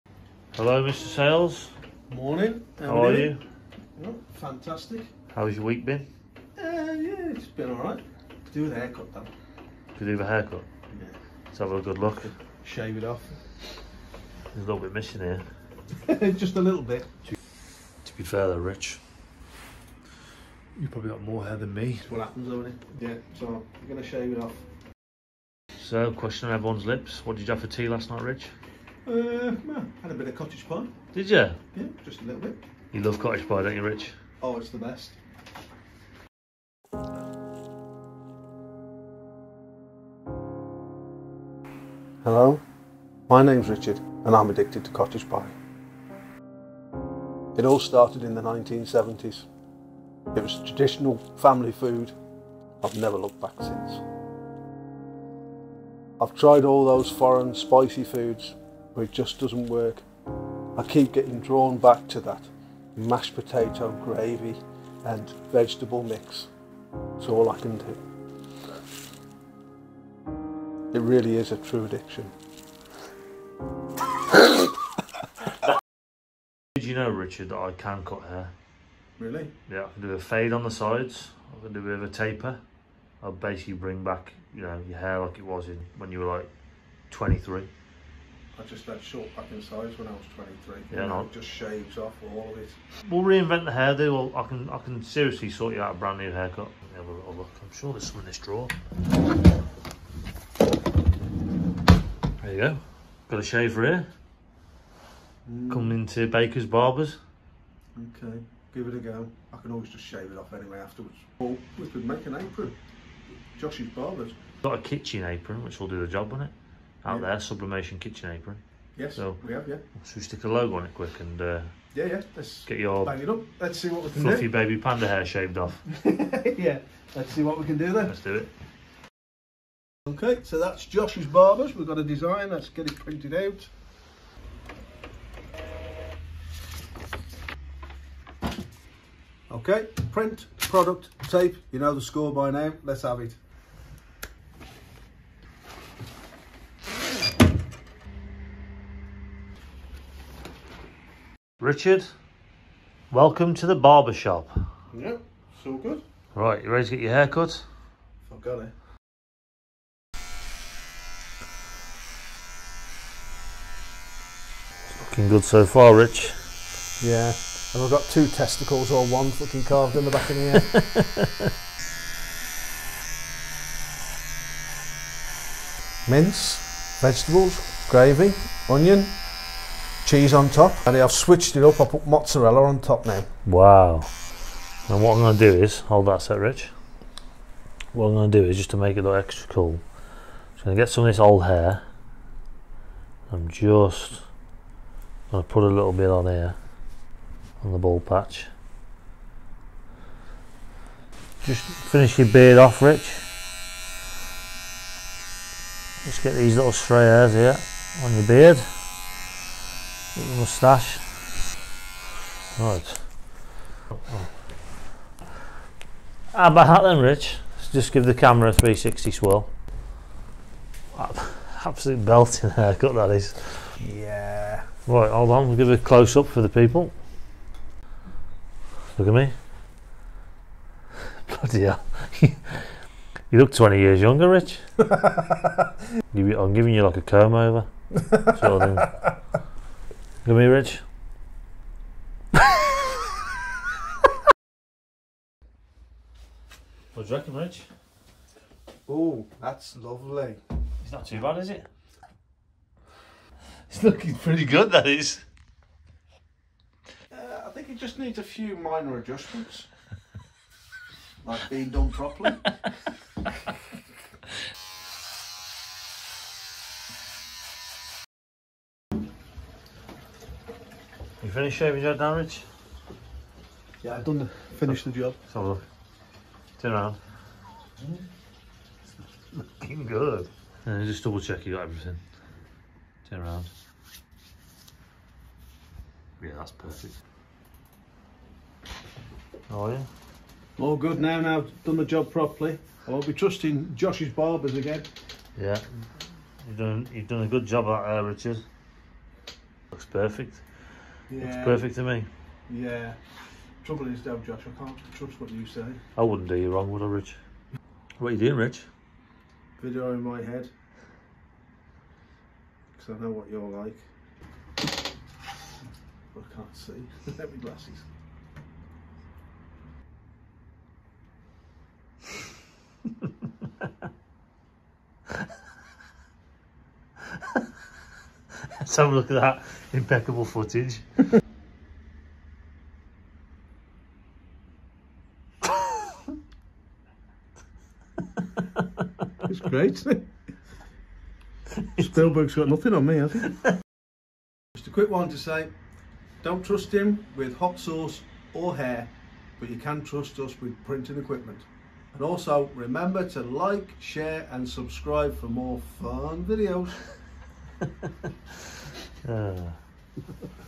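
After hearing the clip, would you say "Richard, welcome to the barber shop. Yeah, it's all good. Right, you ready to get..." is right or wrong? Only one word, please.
right.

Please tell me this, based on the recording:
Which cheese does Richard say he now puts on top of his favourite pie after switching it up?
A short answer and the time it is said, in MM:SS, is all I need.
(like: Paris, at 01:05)
Mozzarella, at 03:02.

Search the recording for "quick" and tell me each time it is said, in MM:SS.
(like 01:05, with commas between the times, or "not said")
02:00, 05:44.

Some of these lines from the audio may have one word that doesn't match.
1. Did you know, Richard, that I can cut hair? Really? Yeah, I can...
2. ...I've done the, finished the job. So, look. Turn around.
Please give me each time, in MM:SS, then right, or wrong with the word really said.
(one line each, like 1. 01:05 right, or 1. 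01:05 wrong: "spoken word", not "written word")
1. 01:16 right
2. 04:33 right.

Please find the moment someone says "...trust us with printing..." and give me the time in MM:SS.
05:49.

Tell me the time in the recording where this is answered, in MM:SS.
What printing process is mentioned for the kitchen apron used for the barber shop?
01:57.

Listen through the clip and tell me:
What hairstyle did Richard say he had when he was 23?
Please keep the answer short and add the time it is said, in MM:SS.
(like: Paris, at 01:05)
Short back and sides, at 01:29.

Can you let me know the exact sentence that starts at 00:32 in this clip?
You love cottage pie, don't you, Rich?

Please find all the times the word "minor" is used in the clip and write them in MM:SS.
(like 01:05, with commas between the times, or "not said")
04:18.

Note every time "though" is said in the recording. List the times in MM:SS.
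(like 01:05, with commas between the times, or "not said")
00:09, 00:18, 00:22, 05:04.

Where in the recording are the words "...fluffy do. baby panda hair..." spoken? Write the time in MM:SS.
02:04.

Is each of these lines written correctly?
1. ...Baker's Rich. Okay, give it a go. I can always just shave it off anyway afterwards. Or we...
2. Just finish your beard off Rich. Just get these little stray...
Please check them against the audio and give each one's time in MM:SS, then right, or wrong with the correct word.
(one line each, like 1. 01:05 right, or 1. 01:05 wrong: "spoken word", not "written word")
1. 01:46 wrong: "Barbers", not "Rich"
2. 03:21 right.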